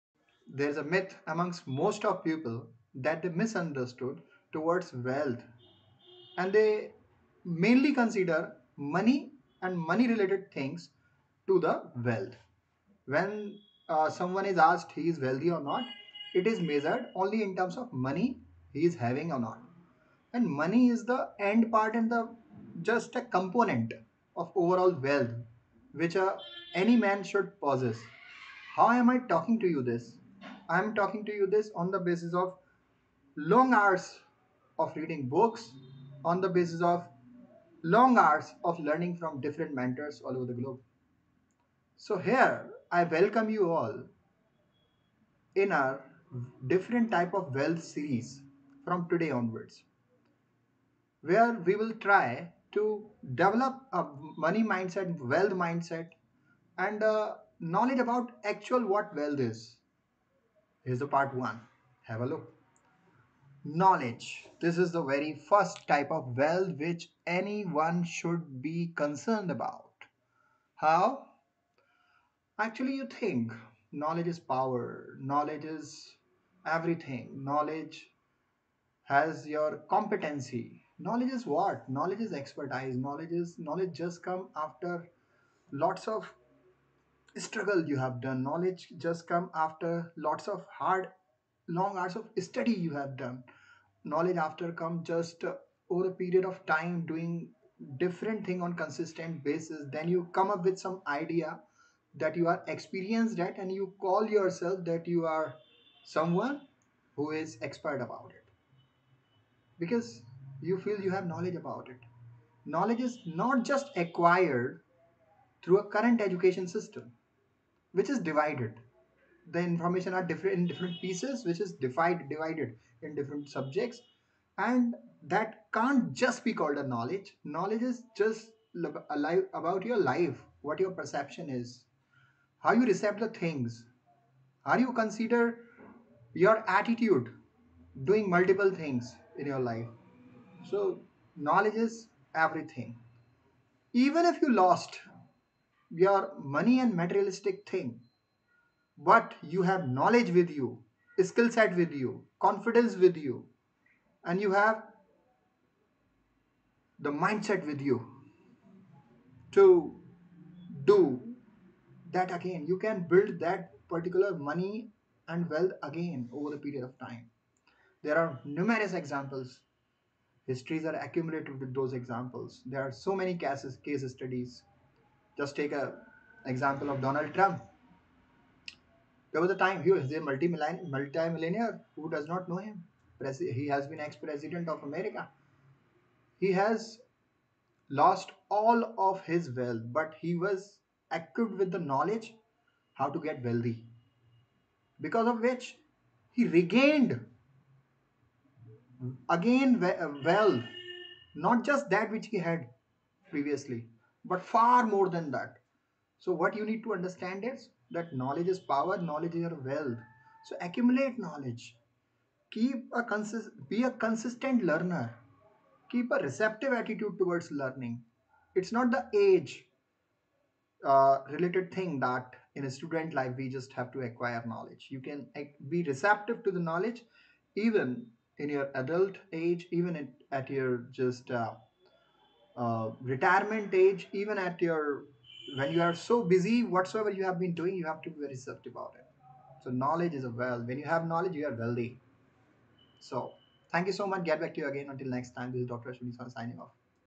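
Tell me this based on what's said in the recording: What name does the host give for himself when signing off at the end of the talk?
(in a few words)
Dr. Ashwani.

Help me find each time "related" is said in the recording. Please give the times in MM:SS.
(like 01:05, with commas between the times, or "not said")
00:10, 03:41.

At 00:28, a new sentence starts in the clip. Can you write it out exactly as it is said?
How am I talking to you this?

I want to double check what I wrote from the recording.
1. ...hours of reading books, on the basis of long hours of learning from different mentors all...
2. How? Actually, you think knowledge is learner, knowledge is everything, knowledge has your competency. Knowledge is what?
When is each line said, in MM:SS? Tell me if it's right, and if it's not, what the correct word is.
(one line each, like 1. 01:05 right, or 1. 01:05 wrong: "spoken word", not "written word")
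1. 00:33 right
2. 01:10 wrong: "power", not "learner".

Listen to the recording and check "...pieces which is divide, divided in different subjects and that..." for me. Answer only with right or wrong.
right.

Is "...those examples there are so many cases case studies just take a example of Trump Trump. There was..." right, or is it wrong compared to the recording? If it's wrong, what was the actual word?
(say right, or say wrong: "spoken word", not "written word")
wrong: "Donald", not "Trump".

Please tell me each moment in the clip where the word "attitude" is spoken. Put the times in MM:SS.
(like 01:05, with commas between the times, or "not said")
02:16, 03:36.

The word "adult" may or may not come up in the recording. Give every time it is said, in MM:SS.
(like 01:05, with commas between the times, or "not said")
03:48.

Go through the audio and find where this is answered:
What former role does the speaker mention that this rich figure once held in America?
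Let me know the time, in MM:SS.
03:03.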